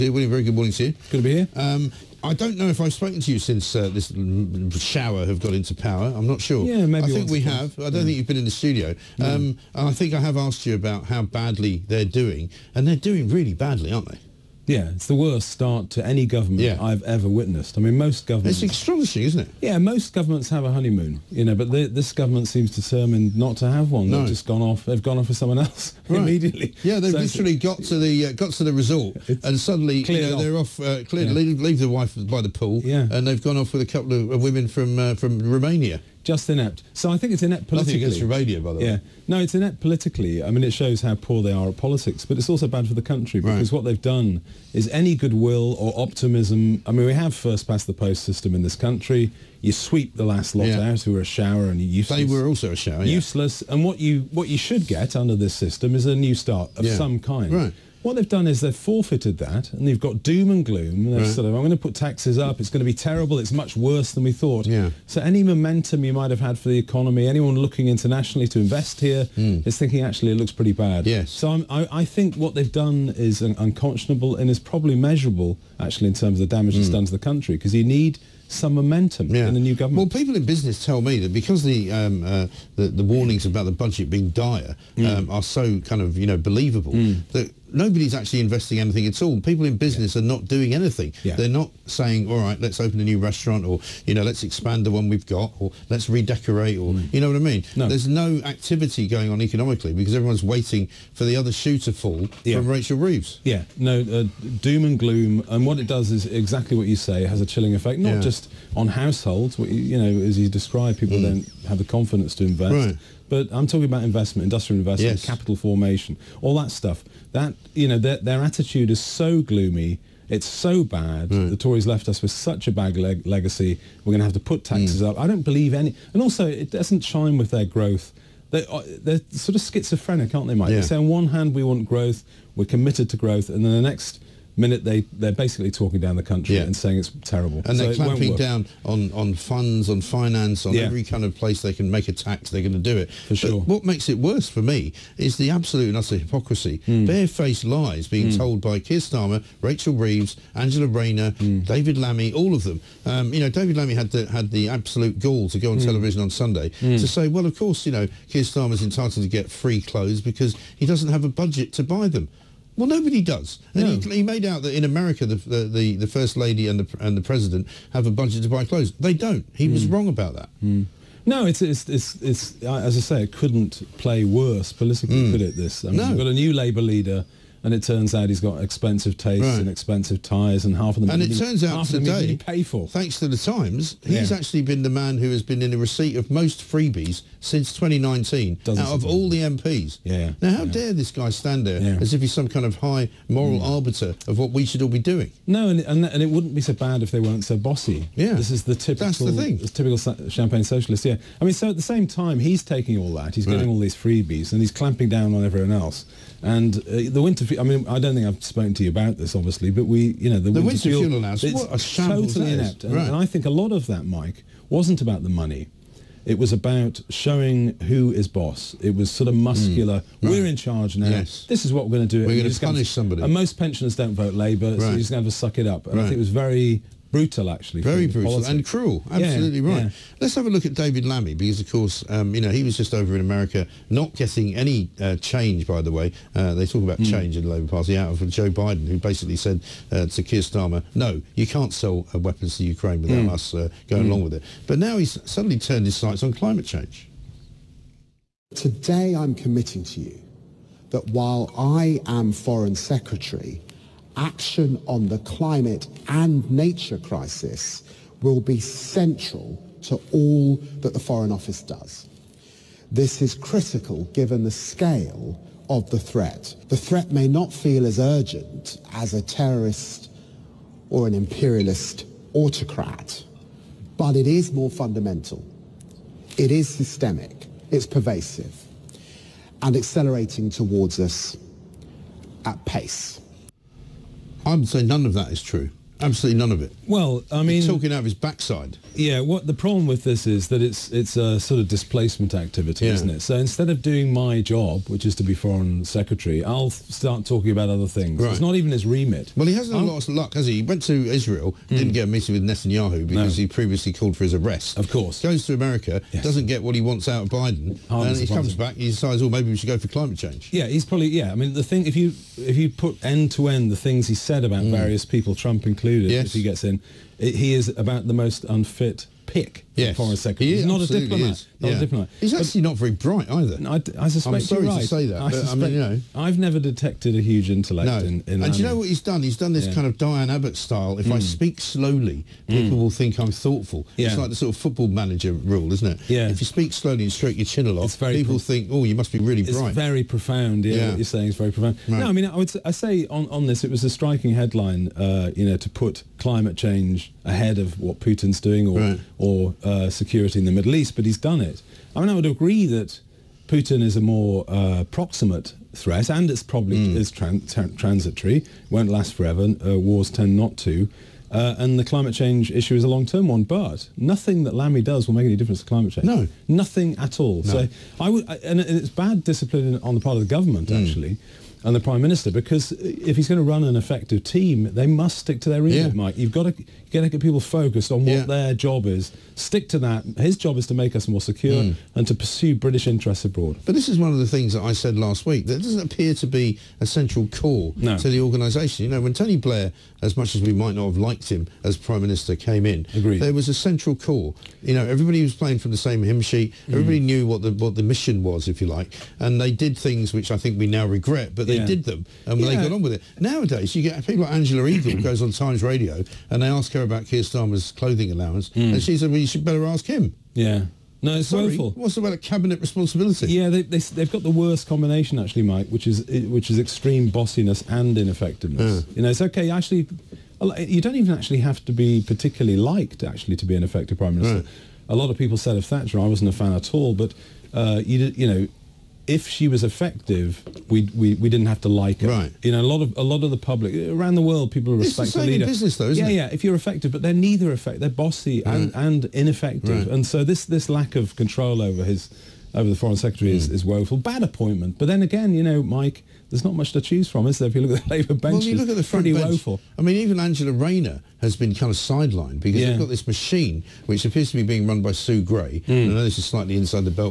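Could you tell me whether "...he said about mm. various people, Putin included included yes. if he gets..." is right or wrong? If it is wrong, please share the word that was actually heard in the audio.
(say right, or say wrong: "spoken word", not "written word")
wrong: "Trump", not "Putin".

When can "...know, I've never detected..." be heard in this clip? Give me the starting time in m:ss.
5:25.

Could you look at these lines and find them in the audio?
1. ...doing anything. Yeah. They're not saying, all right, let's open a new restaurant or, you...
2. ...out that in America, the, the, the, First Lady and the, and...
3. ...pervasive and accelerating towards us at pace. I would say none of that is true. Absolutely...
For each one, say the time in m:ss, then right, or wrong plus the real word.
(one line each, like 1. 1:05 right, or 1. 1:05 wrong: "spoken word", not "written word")
1. 1:30 right
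2. 2:44 right
3. 4:37 right.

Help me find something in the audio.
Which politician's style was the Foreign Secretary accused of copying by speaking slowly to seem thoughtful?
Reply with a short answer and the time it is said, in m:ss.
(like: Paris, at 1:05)
Diane Abbott, at 5:29.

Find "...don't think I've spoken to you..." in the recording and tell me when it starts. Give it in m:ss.
3:27.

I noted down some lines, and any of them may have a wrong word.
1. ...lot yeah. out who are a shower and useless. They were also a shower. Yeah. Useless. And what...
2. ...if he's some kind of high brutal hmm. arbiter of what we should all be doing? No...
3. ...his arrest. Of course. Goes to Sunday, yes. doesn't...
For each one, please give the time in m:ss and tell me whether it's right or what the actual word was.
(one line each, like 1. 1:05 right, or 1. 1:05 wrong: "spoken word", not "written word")
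1. 0:50 right
2. 3:12 wrong: "moral", not "brutal"
3. 5:04 wrong: "America", not "Sunday".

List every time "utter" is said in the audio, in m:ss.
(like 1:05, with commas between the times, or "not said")
2:25.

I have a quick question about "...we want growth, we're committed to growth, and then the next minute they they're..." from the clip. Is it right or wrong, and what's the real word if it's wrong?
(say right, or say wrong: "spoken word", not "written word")
right.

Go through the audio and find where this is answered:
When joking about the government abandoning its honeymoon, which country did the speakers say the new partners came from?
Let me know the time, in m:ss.
0:35.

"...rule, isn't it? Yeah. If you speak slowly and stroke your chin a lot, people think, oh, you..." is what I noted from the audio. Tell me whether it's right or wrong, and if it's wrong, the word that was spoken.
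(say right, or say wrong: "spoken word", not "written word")
right.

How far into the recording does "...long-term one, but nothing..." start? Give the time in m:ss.
6:02.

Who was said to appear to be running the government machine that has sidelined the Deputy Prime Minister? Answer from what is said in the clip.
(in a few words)
Sue Gray.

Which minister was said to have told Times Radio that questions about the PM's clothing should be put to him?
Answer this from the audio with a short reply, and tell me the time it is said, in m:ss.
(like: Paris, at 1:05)
Angela Eagle, at 6:44.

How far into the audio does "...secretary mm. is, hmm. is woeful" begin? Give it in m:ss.
7:22.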